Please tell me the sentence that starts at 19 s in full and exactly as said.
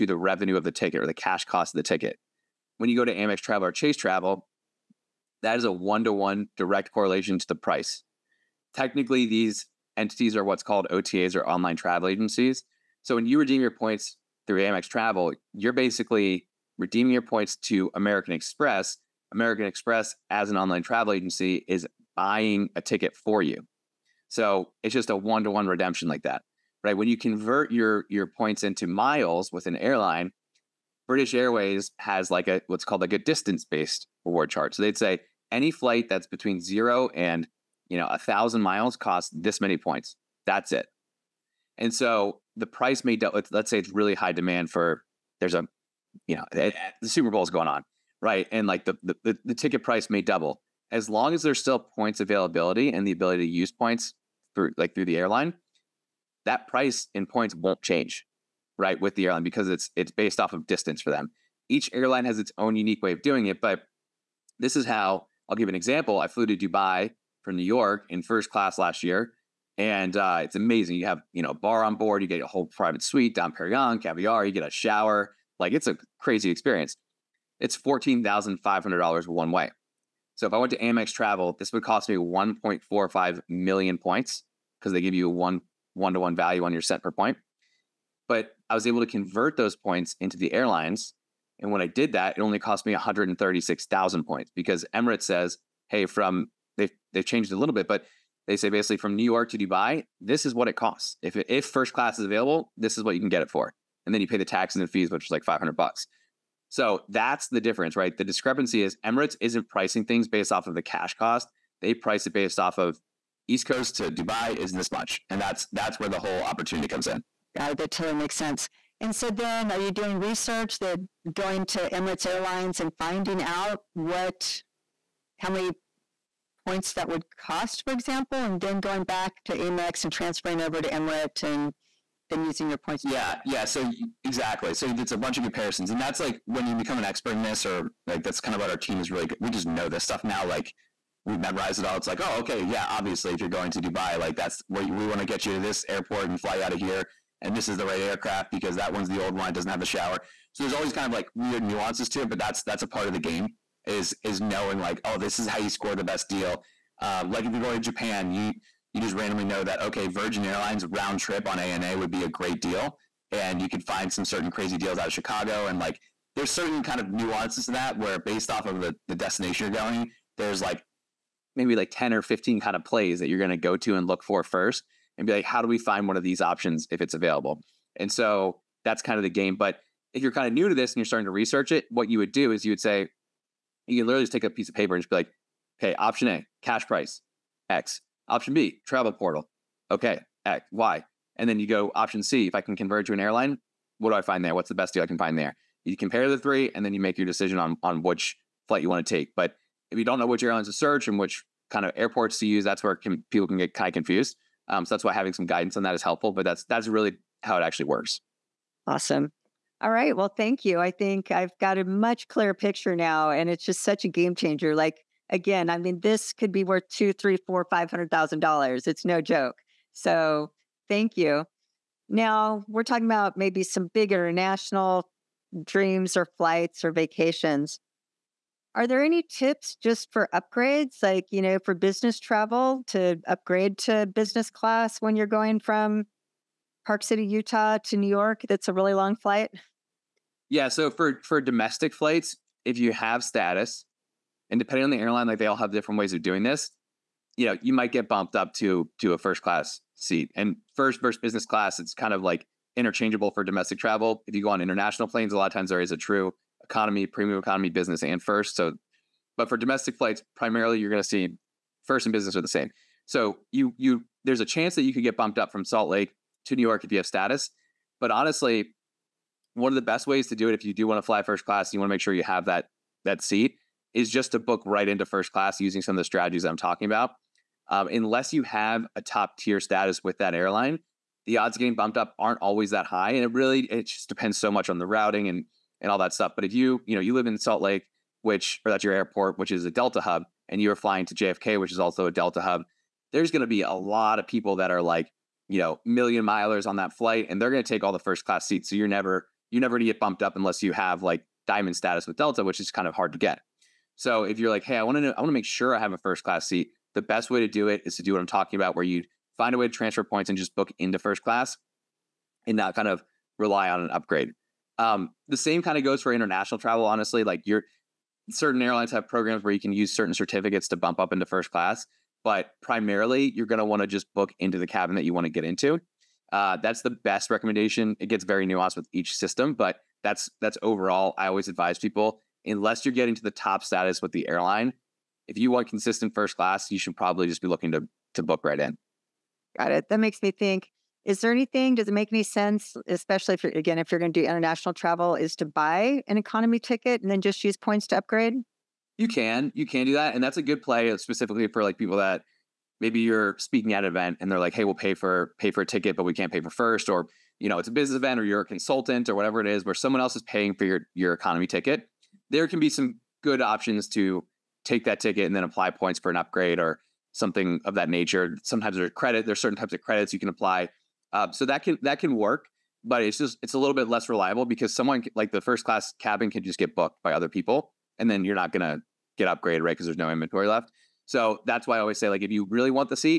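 American Express, as an online travel agency, is buying a ticket for you.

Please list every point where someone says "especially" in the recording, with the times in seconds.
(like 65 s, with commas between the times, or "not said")
342 s.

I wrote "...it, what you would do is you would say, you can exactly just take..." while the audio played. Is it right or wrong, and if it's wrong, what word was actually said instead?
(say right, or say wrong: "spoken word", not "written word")
wrong: "literally", not "exactly".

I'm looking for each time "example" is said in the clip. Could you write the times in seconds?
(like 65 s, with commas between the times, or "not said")
65 s, 127 s.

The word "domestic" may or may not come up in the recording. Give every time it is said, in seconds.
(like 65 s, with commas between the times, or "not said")
241 s, 253 s, 259 s.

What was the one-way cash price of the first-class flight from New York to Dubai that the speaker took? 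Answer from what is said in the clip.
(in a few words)
$14,500.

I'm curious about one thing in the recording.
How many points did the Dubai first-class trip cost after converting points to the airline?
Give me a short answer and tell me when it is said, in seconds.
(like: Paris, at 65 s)
136,000, at 92 s.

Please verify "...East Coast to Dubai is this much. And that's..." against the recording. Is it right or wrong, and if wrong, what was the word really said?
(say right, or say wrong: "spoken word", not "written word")
right.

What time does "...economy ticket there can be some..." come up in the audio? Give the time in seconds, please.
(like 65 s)
361 s.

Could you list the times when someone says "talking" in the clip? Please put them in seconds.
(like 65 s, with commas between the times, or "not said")
222 s, 276 s, 308 s.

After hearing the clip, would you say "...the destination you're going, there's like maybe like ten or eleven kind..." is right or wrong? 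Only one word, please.
wrong.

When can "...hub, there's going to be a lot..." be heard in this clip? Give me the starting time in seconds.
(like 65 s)
292 s.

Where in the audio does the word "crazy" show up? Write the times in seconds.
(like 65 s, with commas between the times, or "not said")
76 s, 164 s.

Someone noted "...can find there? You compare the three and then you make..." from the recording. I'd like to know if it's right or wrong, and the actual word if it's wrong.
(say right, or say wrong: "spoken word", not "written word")
right.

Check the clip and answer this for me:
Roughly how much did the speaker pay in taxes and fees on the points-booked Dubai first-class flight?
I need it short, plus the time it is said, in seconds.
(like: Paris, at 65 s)
$500, at 105 s.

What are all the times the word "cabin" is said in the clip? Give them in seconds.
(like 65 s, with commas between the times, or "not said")
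324 s, 375 s.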